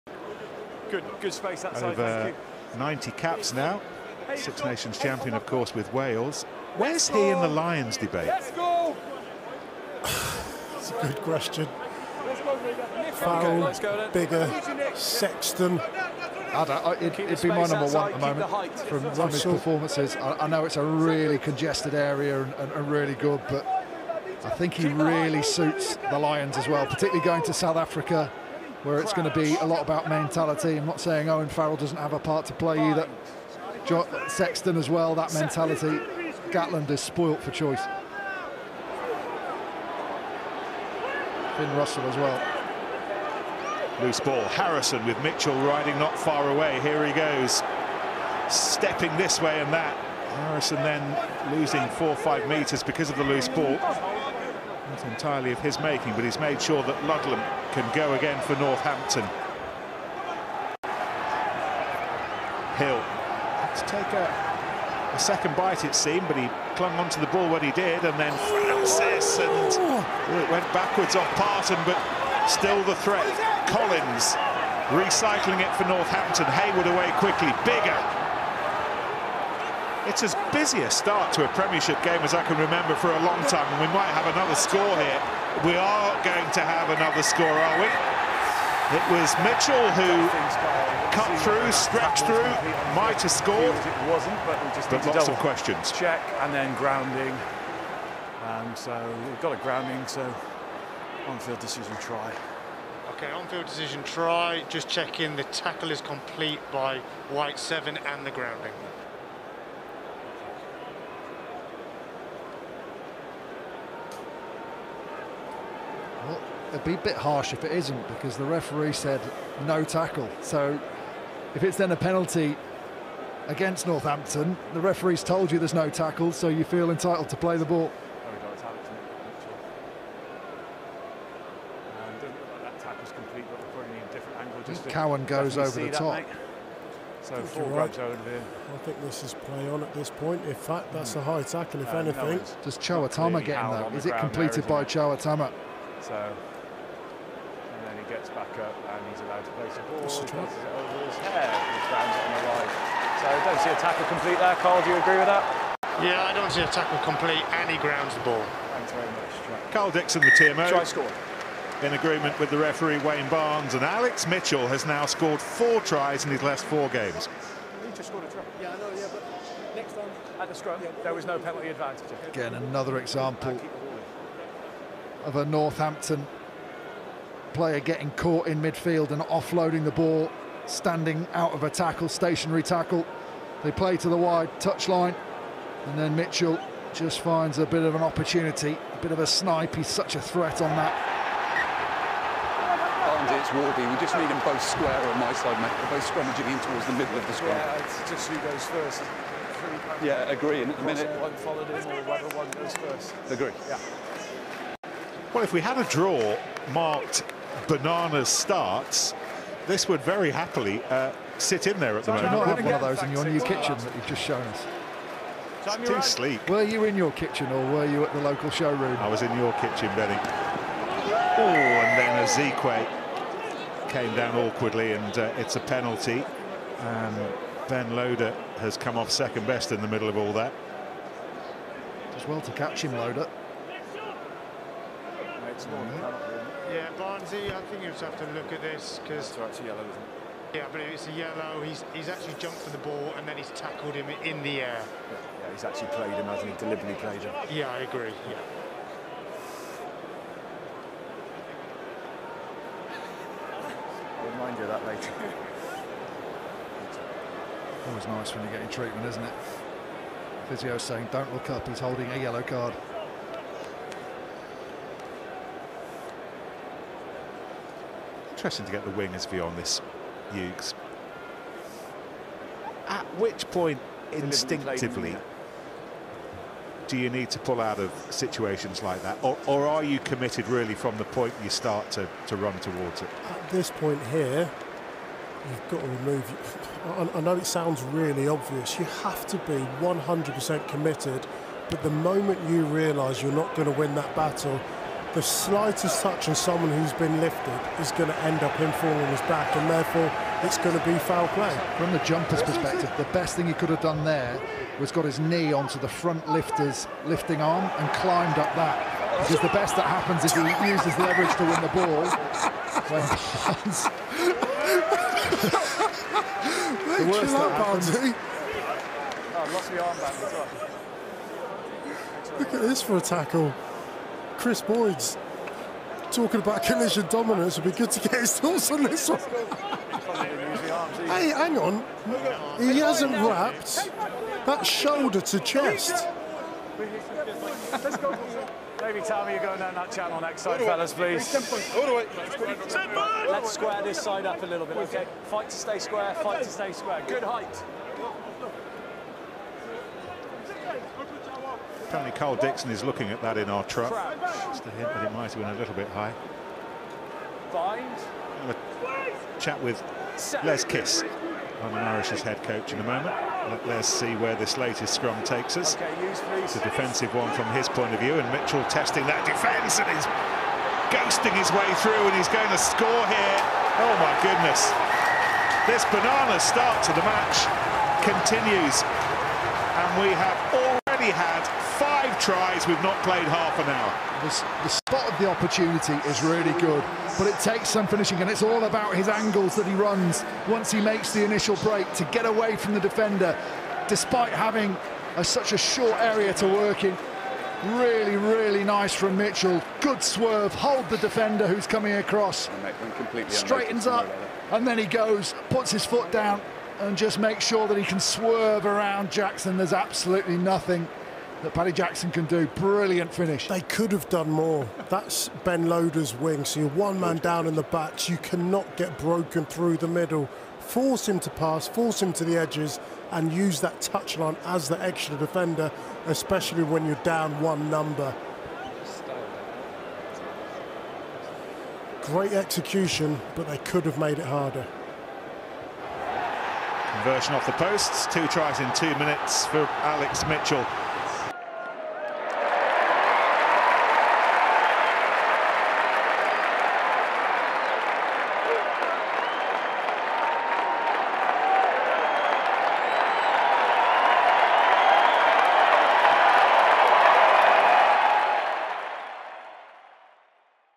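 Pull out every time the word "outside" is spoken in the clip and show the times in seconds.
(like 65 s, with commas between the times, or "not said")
17 s.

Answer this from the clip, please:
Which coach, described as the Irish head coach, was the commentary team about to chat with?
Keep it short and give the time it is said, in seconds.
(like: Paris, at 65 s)
Les Kiss, at 360 s.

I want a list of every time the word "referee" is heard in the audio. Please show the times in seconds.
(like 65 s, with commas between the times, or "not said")
118 s, 124 s, 162 s.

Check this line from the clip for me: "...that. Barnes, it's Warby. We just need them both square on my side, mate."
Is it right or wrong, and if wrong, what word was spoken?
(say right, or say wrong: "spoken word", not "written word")
right.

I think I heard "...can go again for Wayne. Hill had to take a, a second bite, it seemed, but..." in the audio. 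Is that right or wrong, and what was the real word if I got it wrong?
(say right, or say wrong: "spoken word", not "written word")
wrong: "Northampton", not "Wayne".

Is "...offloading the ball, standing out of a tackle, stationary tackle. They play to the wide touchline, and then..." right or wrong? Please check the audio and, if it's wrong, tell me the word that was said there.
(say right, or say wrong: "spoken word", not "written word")
right.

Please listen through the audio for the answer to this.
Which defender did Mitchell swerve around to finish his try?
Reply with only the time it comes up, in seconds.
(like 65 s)
411 s.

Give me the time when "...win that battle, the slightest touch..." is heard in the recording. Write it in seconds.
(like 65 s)
293 s.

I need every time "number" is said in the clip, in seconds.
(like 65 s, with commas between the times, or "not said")
17 s, 427 s.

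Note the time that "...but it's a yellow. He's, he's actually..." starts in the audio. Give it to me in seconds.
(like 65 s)
240 s.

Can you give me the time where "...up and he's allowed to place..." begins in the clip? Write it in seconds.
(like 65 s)
148 s.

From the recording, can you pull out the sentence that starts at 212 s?
you not have one of those in your new kitchen that you've just shown us.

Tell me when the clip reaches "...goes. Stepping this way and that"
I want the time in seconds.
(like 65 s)
47 s.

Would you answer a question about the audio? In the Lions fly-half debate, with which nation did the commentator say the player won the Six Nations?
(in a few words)
Wales.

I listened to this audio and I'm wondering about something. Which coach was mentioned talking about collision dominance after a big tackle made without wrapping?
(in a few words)
Chris Boyd.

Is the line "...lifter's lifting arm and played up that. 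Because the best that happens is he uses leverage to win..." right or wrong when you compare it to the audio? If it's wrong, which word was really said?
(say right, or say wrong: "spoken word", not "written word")
wrong: "climbed", not "played".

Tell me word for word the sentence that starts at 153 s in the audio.
So don't see a tackle complete there, Karl.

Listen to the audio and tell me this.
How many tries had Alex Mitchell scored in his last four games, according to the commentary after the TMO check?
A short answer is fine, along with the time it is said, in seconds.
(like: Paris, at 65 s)
4, at 165 s.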